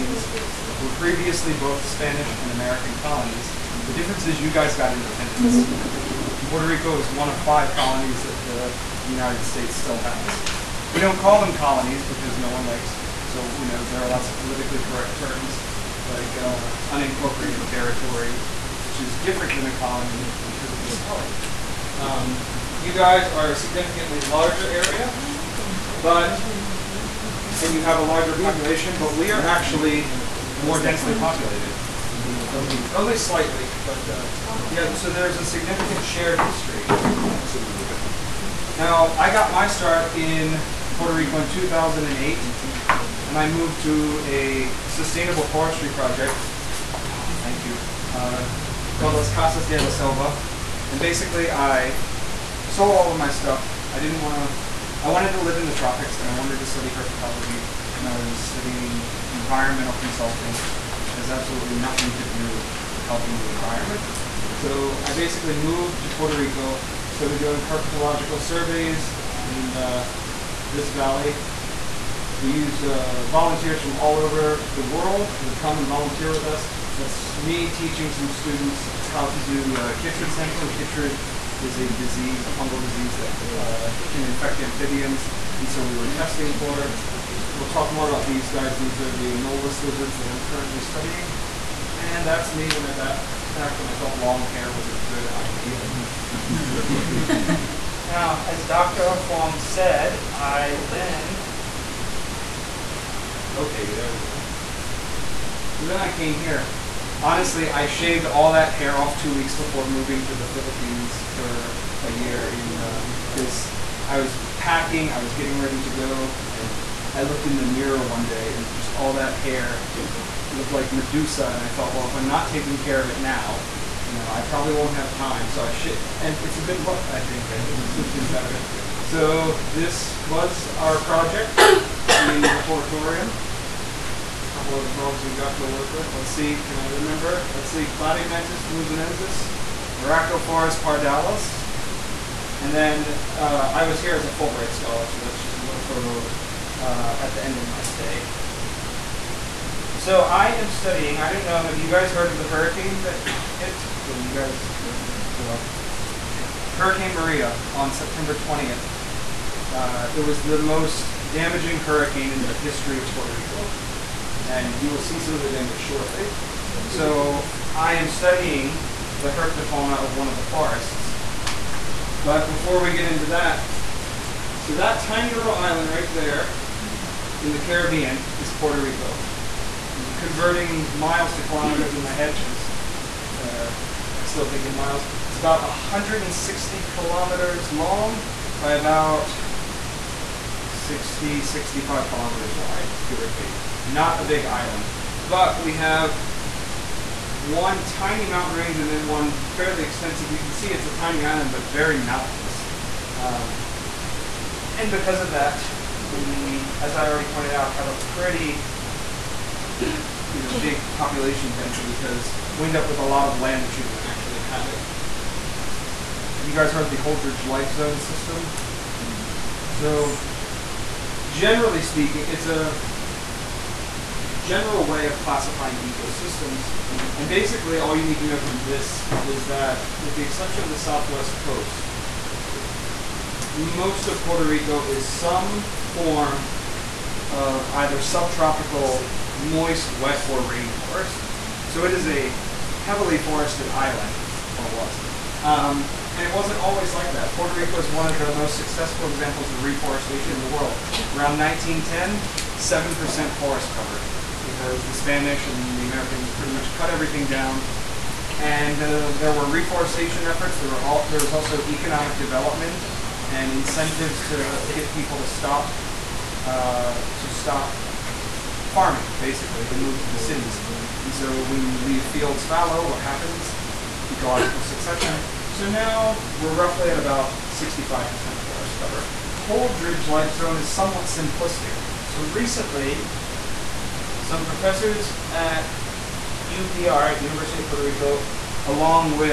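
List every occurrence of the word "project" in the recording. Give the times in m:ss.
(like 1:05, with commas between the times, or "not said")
0:45, 2:11.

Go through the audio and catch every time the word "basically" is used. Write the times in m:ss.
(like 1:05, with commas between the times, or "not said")
0:51, 1:05, 3:47, 4:29.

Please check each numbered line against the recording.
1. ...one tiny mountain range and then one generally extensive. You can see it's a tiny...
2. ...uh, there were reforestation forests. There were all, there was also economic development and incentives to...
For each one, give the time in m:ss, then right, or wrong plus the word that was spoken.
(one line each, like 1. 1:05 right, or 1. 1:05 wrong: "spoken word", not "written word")
1. 3:17 wrong: "fairly", not "generally"
2. 4:18 wrong: "efforts", not "forests".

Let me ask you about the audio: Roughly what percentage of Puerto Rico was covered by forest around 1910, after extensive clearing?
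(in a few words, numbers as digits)
7%.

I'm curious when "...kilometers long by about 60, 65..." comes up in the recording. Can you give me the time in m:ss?
3:06.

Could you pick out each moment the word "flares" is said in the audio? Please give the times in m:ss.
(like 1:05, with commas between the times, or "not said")
not said.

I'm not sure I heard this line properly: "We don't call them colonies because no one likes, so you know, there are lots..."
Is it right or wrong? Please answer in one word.
right.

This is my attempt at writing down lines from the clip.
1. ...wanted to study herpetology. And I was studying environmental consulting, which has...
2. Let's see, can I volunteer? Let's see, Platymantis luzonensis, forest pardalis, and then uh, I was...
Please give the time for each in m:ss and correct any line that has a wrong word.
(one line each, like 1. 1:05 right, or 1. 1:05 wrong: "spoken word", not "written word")
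1. 0:56 right
2. 2:16 wrong: "remember", not "volunteer".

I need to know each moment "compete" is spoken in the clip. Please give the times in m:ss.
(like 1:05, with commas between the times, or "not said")
not said.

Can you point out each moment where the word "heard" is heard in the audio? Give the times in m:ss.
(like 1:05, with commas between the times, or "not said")
2:32, 3:36.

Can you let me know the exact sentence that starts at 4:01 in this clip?
So it is a heavily forested island, or was.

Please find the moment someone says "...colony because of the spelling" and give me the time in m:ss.
0:19.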